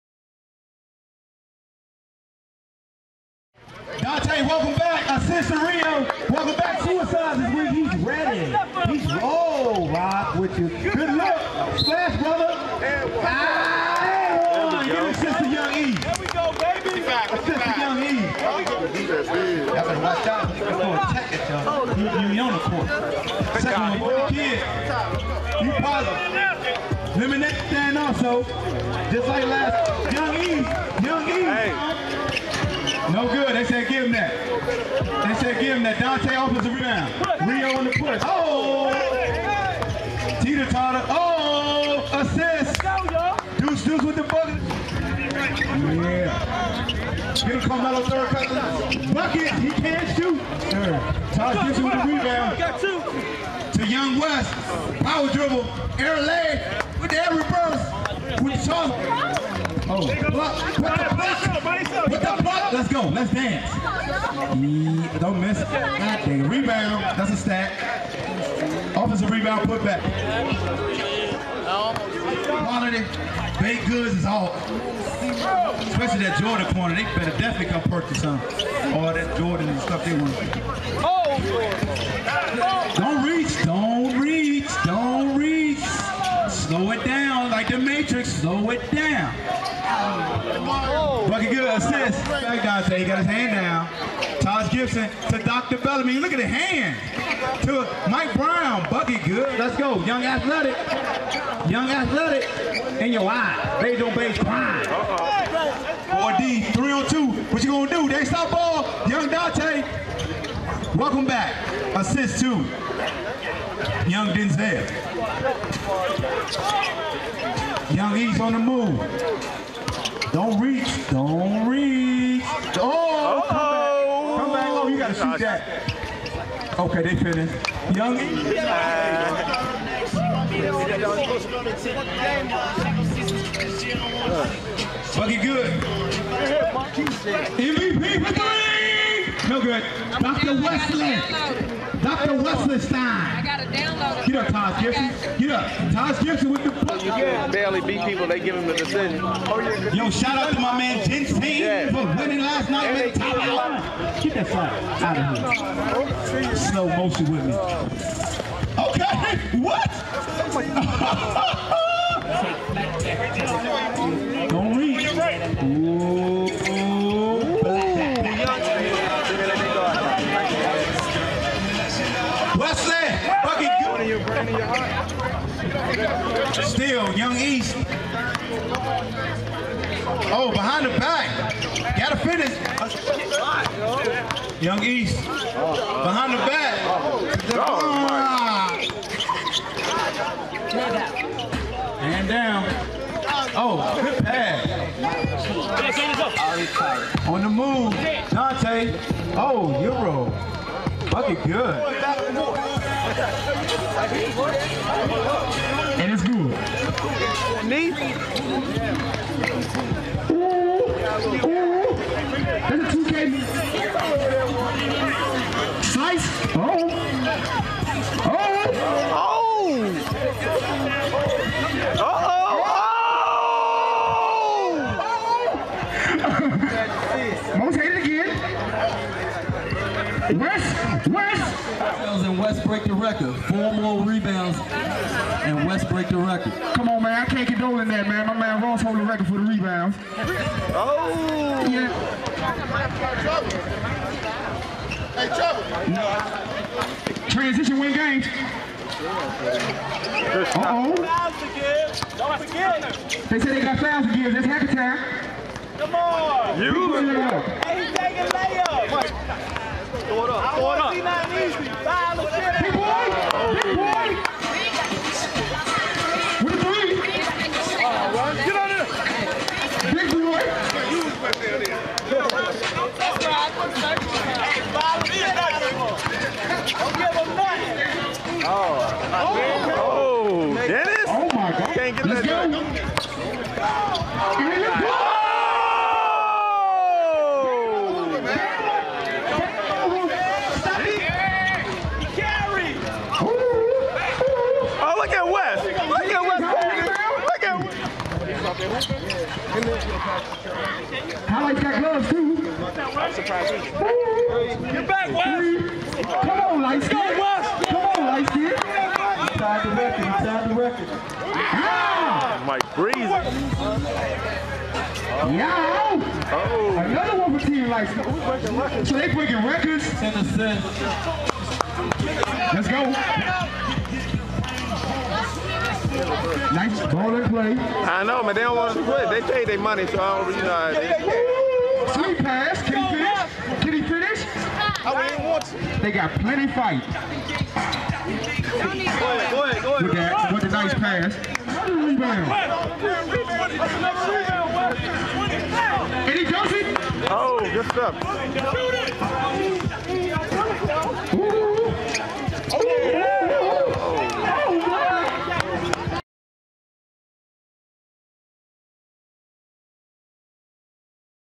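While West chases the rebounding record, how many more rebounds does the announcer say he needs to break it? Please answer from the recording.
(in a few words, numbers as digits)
4.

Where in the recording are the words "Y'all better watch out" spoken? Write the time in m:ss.
0:18.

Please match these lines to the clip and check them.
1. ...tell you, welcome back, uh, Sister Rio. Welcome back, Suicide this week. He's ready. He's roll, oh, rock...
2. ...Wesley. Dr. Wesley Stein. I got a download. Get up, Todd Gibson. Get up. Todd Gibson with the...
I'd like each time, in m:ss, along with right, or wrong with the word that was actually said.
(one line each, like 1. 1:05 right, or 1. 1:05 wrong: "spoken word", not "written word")
1. 0:04 right
2. 2:20 right.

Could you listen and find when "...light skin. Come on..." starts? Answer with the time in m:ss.
5:06.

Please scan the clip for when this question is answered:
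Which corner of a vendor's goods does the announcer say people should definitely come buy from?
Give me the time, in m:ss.
1:16.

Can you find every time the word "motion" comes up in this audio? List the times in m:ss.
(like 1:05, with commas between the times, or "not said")
2:36.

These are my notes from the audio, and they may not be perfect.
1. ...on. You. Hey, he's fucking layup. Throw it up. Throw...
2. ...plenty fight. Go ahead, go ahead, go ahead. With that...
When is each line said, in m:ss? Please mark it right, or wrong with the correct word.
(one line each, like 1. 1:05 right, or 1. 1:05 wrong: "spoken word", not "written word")
1. 4:15 wrong: "taking", not "fucking"
2. 5:36 right.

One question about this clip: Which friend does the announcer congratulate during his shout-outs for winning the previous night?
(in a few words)
Jinteen.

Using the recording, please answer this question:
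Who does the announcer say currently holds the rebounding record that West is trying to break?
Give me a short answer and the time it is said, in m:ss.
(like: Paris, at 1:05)
Ross, at 3:58.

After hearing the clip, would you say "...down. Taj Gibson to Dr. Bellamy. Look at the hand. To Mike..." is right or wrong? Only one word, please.
right.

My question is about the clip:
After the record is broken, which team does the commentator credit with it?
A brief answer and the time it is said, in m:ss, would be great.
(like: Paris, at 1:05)
Team Lights, at 5:17.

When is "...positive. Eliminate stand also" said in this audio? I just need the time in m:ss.
0:25.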